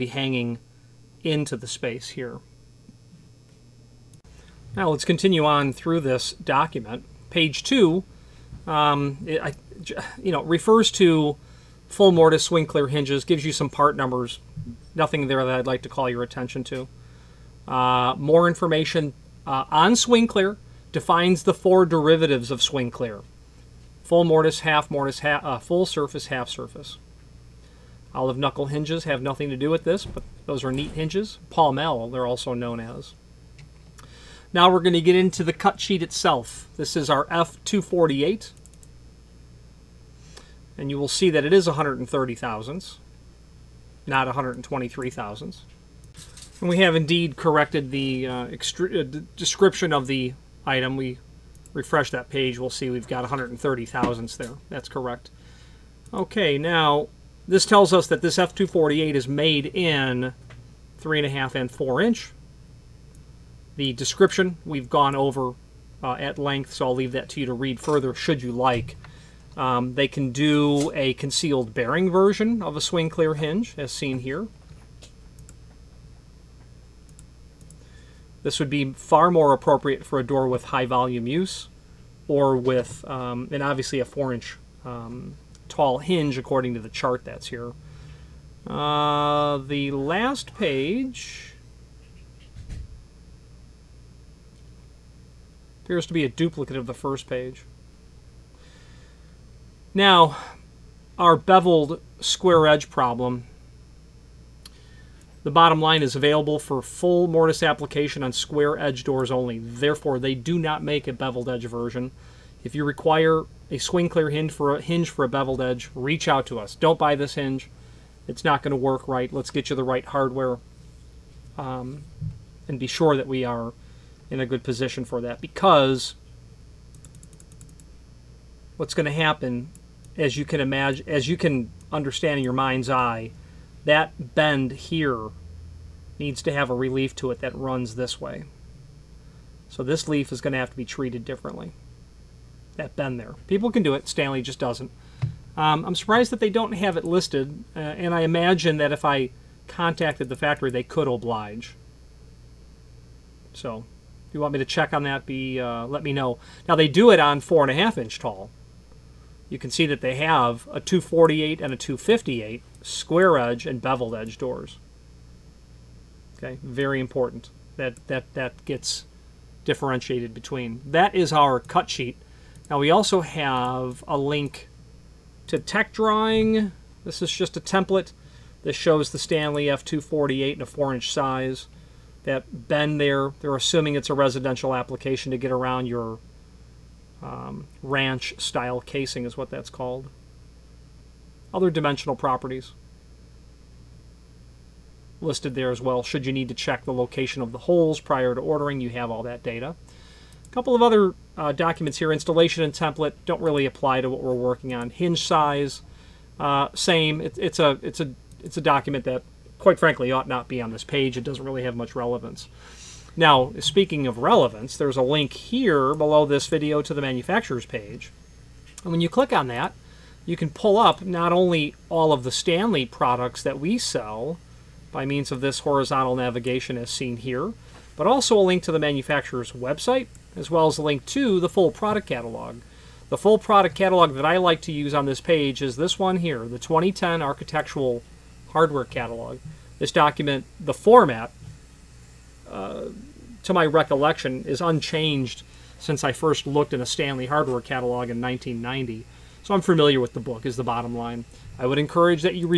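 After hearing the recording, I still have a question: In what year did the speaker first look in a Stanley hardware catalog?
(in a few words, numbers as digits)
1990.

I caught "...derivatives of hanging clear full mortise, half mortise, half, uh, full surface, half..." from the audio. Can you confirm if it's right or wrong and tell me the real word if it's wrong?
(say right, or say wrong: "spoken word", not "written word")
wrong: "swing", not "hanging".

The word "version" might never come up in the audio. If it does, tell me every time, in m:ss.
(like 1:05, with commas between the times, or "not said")
1:12, 1:51.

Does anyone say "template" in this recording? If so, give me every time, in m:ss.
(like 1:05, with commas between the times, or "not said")
2:57, 3:22.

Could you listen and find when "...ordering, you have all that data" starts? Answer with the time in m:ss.
3:18.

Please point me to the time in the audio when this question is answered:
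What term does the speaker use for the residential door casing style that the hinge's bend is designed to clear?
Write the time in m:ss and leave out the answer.
3:07.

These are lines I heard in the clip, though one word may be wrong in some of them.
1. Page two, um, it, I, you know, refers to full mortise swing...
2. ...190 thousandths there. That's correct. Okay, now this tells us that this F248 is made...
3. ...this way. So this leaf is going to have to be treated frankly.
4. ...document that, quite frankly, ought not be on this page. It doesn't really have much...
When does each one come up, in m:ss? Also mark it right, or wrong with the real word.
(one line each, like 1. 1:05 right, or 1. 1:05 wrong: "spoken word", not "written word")
1. 0:07 right
2. 0:53 wrong: "130", not "190"
3. 2:17 wrong: "differently", not "frankly"
4. 3:28 right.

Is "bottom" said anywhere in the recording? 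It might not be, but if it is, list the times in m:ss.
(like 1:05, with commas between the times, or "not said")
1:45, 4:10.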